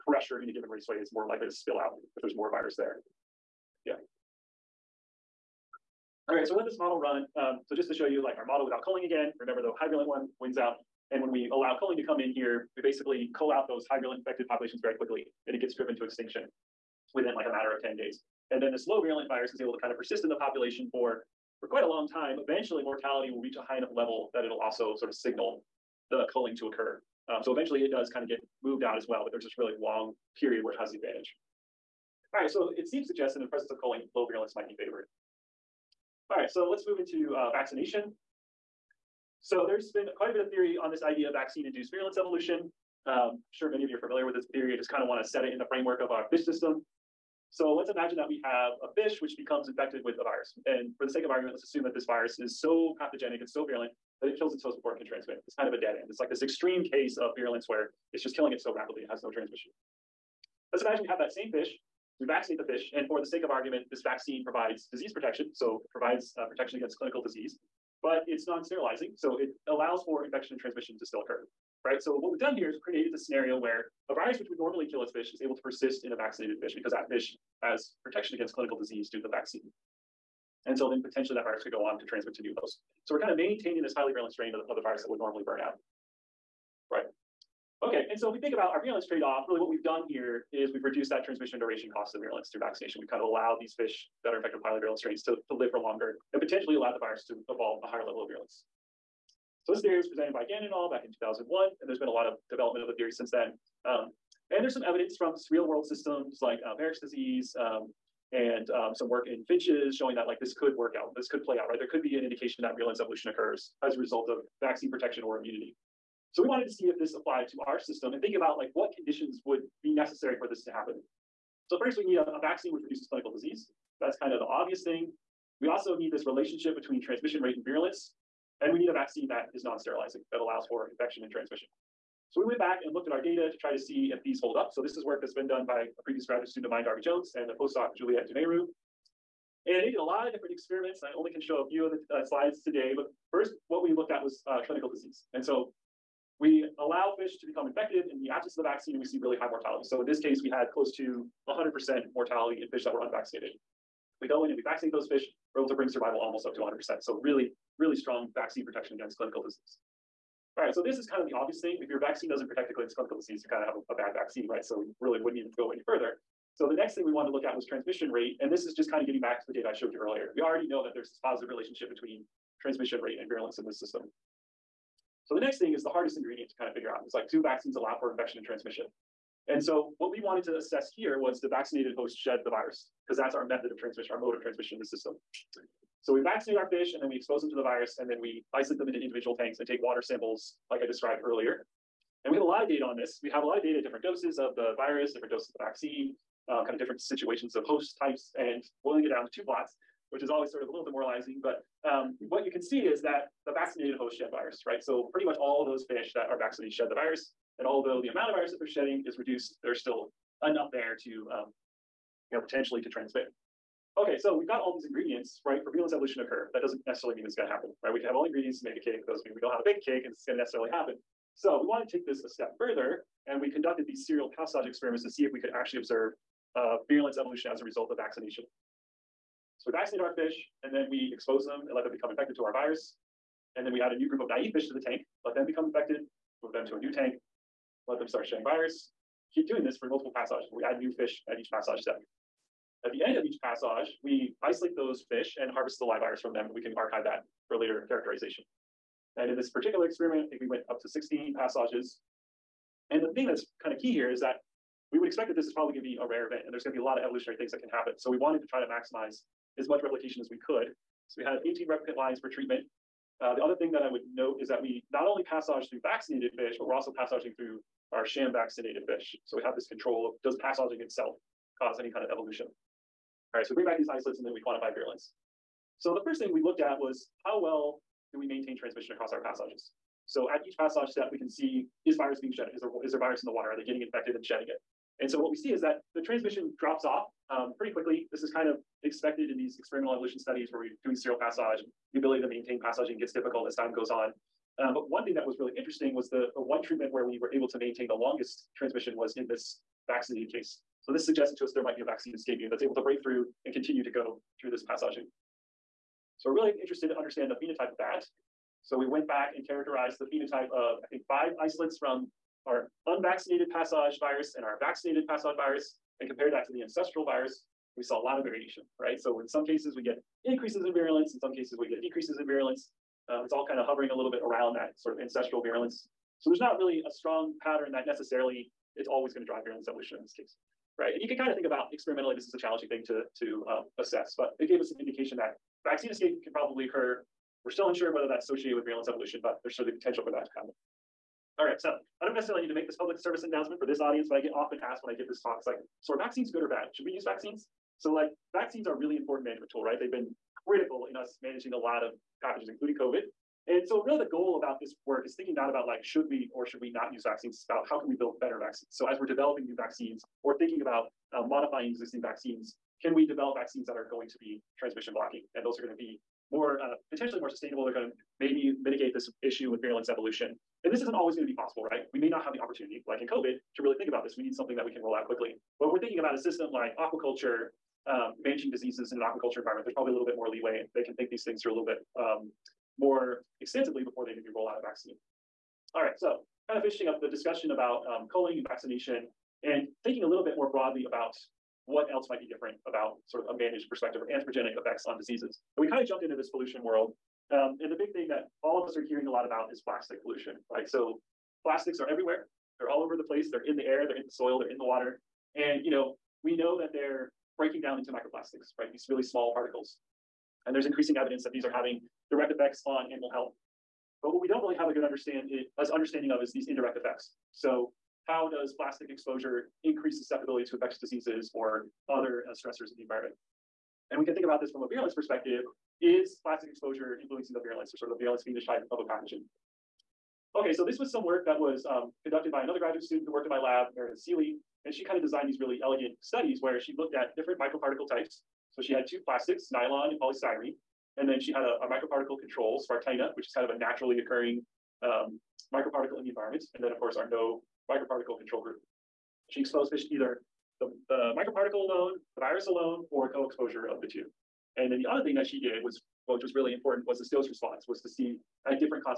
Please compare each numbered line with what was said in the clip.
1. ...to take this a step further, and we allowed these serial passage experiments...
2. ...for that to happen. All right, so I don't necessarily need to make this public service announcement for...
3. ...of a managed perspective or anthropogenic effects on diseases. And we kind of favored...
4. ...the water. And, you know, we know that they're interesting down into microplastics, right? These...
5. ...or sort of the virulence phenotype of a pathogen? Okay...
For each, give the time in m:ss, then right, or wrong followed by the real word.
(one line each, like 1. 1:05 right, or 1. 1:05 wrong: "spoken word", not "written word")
1. 3:41 wrong: "conducted", not "allowed"
2. 5:40 right
3. 6:33 wrong: "jumped", not "favored"
4. 6:44 wrong: "breaking", not "interesting"
5. 7:07 right.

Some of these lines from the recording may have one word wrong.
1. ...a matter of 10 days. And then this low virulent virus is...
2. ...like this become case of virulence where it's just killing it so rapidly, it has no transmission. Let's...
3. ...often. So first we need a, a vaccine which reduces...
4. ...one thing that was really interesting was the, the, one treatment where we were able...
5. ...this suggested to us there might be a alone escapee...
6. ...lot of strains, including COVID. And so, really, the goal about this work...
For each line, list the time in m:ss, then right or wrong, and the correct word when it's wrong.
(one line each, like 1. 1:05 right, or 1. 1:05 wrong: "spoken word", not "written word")
1. 0:17 right
2. 0:56 wrong: "extreme", not "become"
3. 2:00 wrong: "happen", not "often"
4. 4:54 right
5. 5:00 wrong: "vaccine", not "alone"
6. 5:51 wrong: "pathogens", not "strains".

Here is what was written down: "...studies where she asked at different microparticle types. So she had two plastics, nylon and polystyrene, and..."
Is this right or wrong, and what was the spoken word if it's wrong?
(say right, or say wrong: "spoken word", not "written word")
wrong: "looked", not "asked".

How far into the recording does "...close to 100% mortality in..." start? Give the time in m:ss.
2:30.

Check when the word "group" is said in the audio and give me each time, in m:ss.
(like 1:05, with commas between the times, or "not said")
3:54, 7:28.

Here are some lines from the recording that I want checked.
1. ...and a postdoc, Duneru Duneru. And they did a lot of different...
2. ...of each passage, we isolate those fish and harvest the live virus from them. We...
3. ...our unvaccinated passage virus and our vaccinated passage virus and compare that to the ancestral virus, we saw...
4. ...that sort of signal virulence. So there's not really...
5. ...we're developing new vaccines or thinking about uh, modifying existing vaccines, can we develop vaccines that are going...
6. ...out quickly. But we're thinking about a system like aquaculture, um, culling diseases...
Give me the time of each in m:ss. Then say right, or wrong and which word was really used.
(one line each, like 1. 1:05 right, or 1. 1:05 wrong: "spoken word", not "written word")
1. 2:17 wrong: "Juliette", not "Duneru"
2. 4:03 right
3. 5:12 right
4. 5:24 wrong: "ancestral", not "signal"
5. 5:58 right
6. 6:14 wrong: "managing", not "culling".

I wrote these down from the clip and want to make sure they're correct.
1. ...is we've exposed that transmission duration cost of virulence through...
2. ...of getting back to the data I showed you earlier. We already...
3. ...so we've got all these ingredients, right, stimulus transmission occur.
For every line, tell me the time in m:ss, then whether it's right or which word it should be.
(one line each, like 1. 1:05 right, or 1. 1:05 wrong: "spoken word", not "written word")
1. 1:30 wrong: "reduced", not "exposed"
2. 2:49 right
3. 3:34 wrong: "evolution", not "transmission".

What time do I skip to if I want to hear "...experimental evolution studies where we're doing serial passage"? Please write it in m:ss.
4:49.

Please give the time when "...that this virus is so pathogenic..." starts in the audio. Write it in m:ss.
0:51.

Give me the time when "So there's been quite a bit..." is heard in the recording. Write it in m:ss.
0:39.